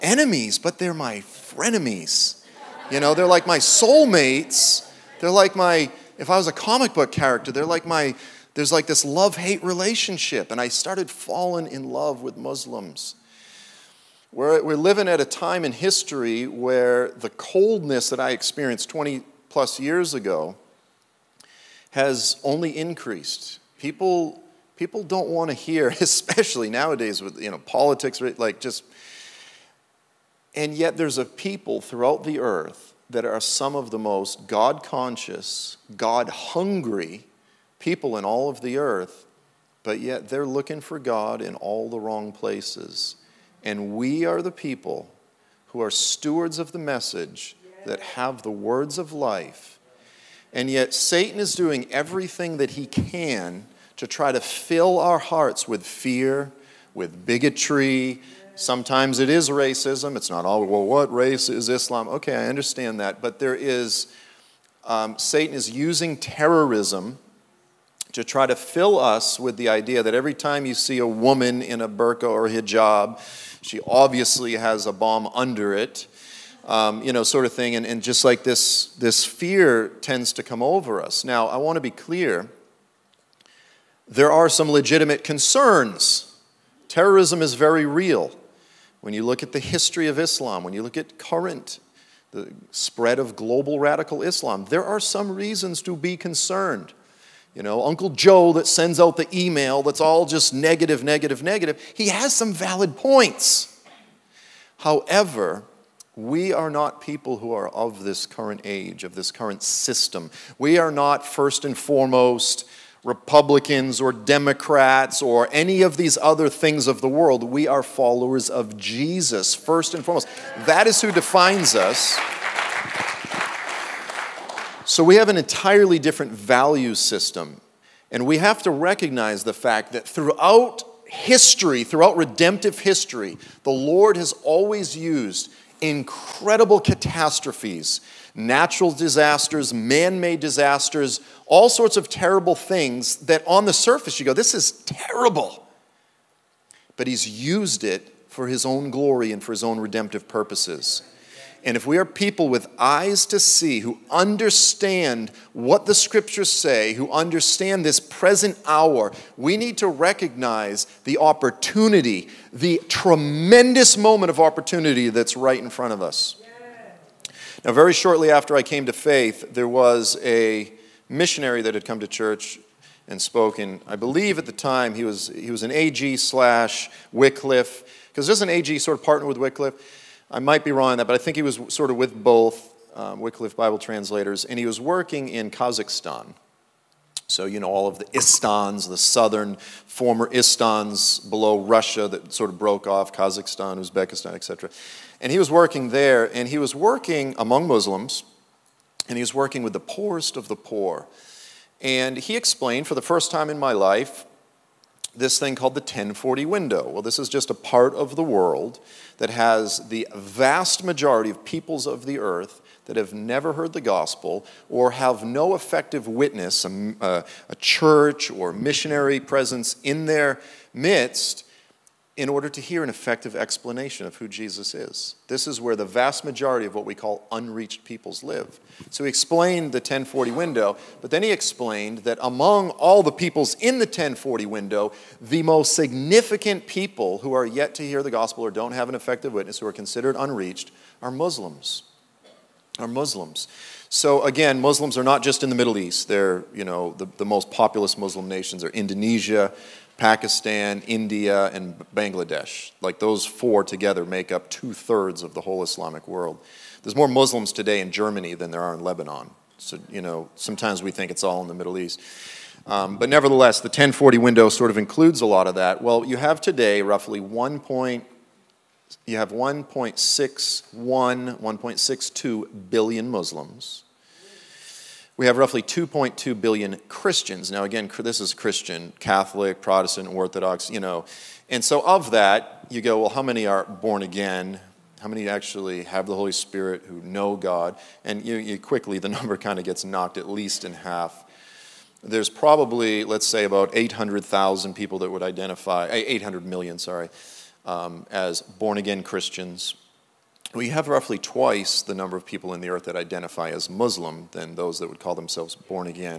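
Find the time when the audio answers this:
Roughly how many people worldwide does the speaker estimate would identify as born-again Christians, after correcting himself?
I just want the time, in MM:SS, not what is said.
04:55.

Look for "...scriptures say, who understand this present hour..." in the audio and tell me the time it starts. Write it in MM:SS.
02:35.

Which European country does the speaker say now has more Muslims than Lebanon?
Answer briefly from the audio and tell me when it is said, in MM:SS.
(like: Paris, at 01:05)
Germany, at 04:17.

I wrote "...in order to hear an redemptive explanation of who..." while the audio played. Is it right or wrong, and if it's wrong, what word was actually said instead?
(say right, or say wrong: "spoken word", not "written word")
wrong: "effective", not "redemptive".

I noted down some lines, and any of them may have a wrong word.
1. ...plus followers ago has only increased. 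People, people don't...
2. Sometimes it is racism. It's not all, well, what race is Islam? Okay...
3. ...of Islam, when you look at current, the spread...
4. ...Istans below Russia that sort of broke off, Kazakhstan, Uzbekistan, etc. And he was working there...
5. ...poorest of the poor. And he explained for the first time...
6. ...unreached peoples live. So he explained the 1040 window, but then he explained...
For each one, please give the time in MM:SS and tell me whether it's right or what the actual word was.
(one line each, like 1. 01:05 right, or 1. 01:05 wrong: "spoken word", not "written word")
1. 00:19 wrong: "years", not "followers"
2. 00:58 right
3. 01:30 right
4. 03:10 right
5. 03:19 right
6. 03:47 right.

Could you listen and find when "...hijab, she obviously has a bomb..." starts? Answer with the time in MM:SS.
01:12.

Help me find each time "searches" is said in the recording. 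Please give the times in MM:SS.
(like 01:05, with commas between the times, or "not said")
not said.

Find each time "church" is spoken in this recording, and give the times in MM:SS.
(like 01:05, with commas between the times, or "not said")
02:52, 03:37.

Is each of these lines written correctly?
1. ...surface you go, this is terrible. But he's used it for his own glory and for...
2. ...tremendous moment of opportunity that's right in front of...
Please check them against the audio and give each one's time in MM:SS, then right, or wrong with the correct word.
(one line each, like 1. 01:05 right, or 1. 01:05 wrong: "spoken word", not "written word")
1. 02:23 right
2. 02:42 right.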